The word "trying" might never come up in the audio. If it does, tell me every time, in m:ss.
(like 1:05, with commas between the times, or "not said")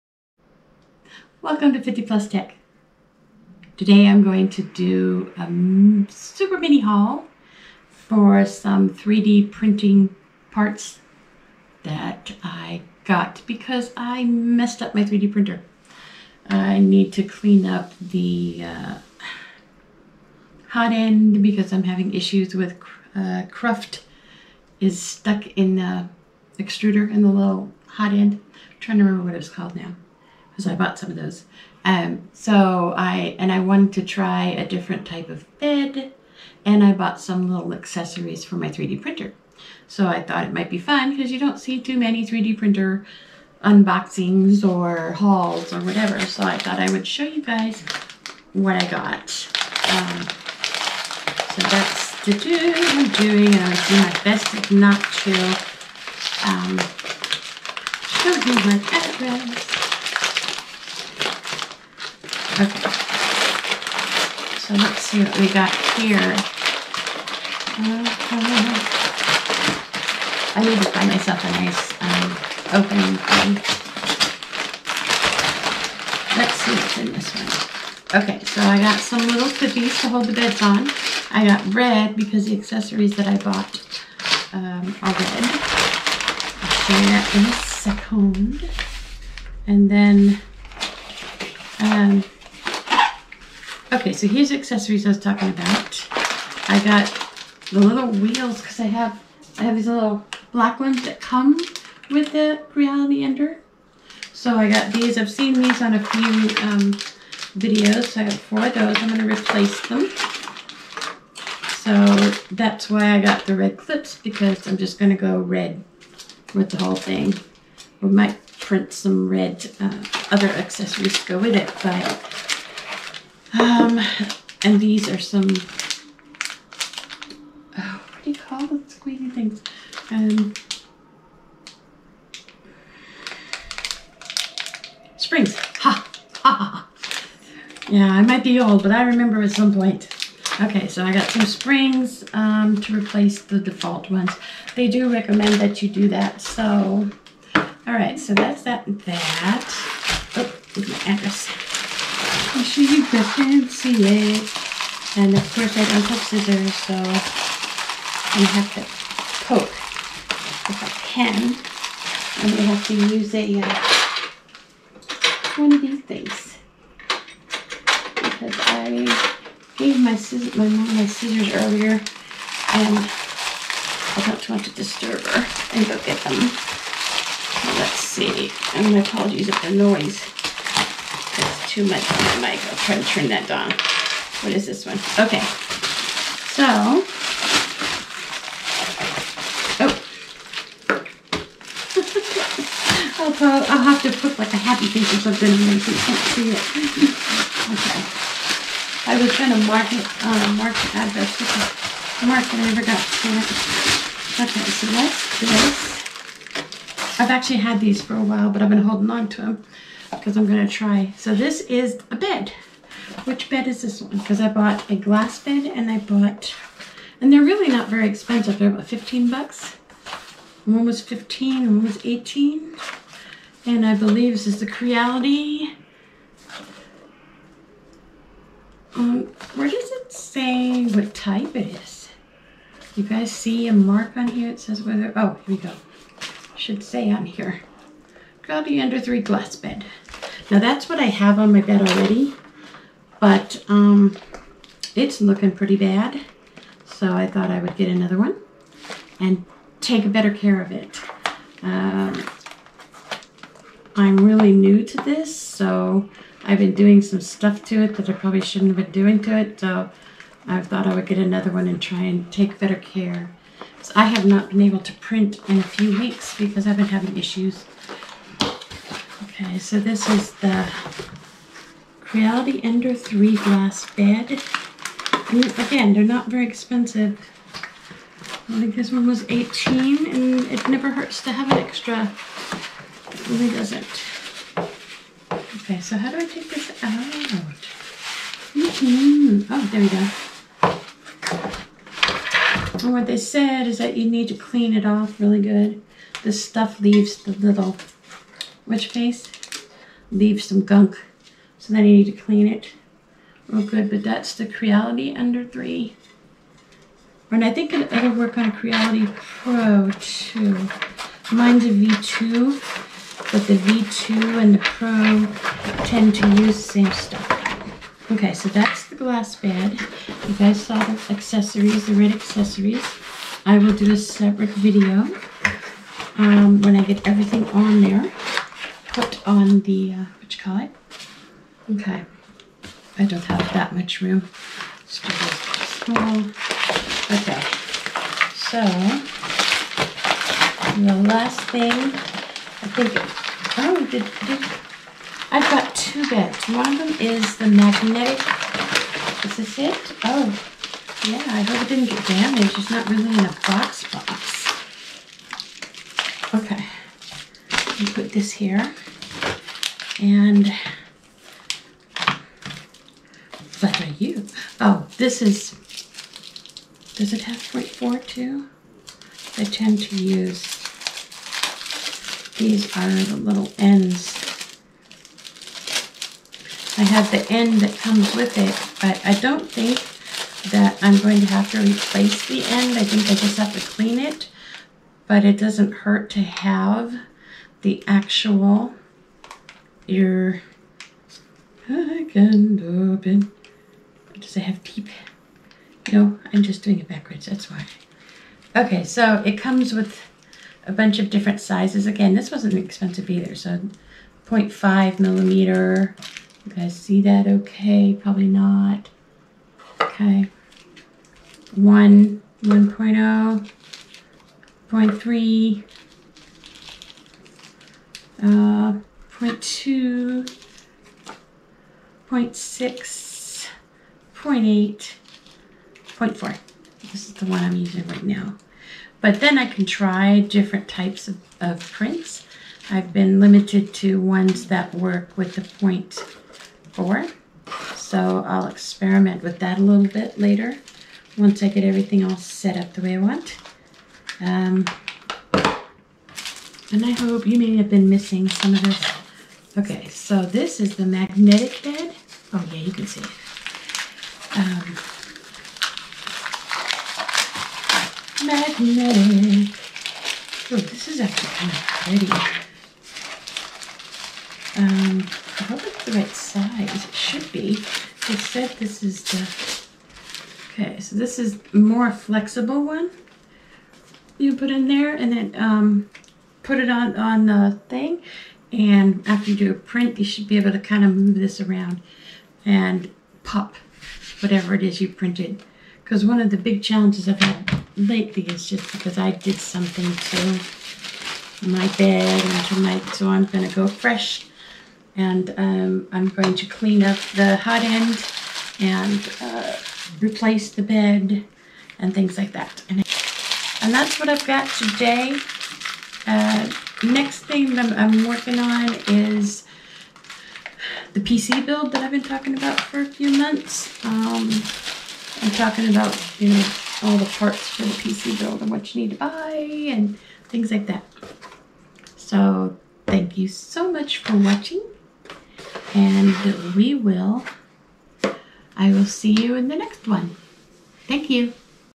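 0:28.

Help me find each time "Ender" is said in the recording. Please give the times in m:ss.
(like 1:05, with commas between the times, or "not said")
1:43, 3:58, 4:32, 5:05.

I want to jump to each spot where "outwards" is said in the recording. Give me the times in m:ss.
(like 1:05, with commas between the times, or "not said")
not said.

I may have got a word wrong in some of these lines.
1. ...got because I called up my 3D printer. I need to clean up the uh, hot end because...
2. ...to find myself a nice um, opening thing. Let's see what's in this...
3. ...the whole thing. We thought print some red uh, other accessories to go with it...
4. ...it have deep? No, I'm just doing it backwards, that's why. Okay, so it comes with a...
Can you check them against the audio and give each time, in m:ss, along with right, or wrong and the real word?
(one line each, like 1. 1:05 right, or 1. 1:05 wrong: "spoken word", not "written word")
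1. 0:13 wrong: "messed", not "called"
2. 1:10 right
3. 1:56 wrong: "might", not "thought"
4. 6:34 right.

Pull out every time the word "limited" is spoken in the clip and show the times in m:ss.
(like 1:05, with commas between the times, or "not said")
7:13.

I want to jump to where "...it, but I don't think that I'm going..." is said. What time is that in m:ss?
6:18.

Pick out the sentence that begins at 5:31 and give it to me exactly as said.
Okay, I don't have that much room.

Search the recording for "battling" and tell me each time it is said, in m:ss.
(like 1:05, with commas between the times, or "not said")
not said.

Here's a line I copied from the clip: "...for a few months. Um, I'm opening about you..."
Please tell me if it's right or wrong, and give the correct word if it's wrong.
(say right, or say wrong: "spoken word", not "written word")
wrong: "talking", not "opening".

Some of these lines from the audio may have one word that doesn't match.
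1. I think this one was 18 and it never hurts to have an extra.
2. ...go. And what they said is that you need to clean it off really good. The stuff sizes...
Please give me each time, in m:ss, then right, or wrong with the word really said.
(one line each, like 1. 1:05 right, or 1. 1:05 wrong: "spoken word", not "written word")
1. 4:38 right
2. 4:49 wrong: "leaves", not "sizes".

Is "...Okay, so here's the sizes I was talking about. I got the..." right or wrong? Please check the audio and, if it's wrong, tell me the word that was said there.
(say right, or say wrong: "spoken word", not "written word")
wrong: "accessories", not "sizes".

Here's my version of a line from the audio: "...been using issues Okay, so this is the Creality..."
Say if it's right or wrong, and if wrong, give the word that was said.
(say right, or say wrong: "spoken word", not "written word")
wrong: "having", not "using".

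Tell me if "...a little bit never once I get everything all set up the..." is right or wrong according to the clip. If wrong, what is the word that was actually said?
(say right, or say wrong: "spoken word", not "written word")
wrong: "later", not "never".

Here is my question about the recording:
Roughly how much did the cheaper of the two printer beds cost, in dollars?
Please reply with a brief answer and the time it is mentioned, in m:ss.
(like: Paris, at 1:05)
15, at 3:38.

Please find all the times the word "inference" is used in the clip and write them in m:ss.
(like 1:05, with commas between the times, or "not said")
not said.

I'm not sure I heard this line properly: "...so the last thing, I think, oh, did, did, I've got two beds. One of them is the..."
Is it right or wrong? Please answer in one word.
right.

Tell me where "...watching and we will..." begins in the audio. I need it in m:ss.
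8:44.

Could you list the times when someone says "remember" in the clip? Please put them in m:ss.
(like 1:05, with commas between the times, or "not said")
0:29, 2:19.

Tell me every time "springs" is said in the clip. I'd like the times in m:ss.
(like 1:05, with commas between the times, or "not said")
2:15, 2:21.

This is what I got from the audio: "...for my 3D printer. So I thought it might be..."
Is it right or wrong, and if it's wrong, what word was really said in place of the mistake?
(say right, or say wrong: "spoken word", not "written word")
right.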